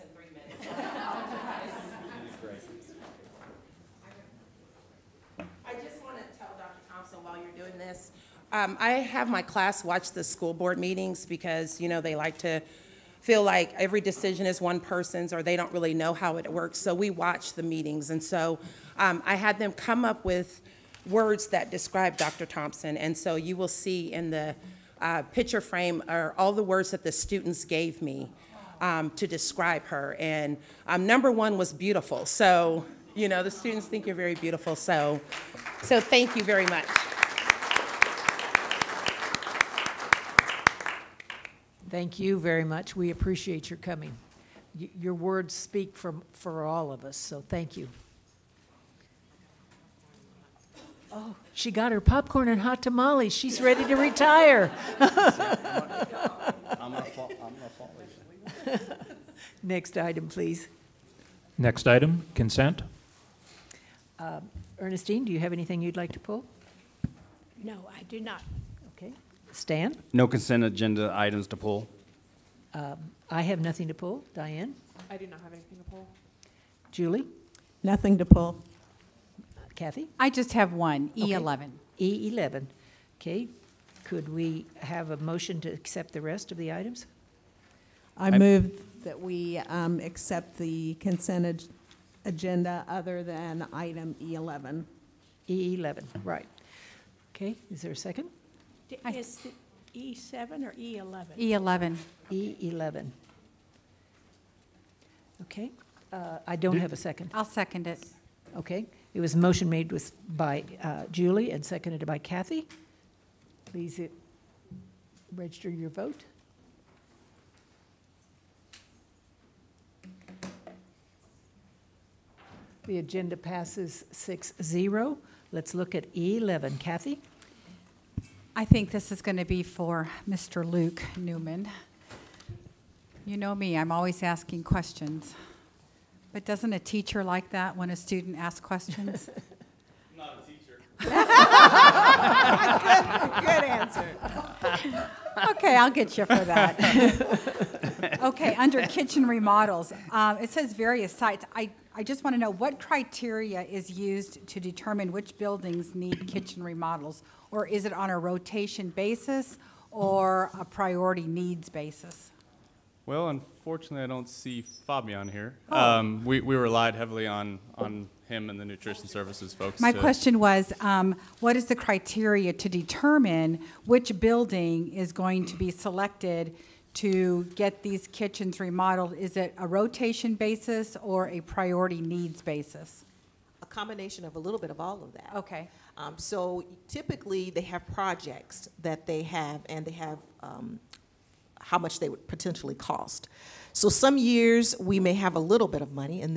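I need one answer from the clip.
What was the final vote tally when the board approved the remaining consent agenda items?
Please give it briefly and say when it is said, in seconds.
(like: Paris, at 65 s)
6-0, at 124 s.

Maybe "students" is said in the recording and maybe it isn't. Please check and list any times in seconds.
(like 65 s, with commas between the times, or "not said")
27 s, 33 s, 137 s.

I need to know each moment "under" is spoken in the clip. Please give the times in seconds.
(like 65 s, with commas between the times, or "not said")
148 s.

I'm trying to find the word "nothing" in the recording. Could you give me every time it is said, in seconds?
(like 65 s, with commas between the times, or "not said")
73 s, 77 s.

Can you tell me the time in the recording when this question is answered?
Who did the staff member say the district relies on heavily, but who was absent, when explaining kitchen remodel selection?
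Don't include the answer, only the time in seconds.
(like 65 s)
164 s.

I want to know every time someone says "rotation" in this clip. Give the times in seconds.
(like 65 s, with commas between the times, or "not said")
158 s, 179 s.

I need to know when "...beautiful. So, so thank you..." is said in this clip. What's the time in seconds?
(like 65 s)
34 s.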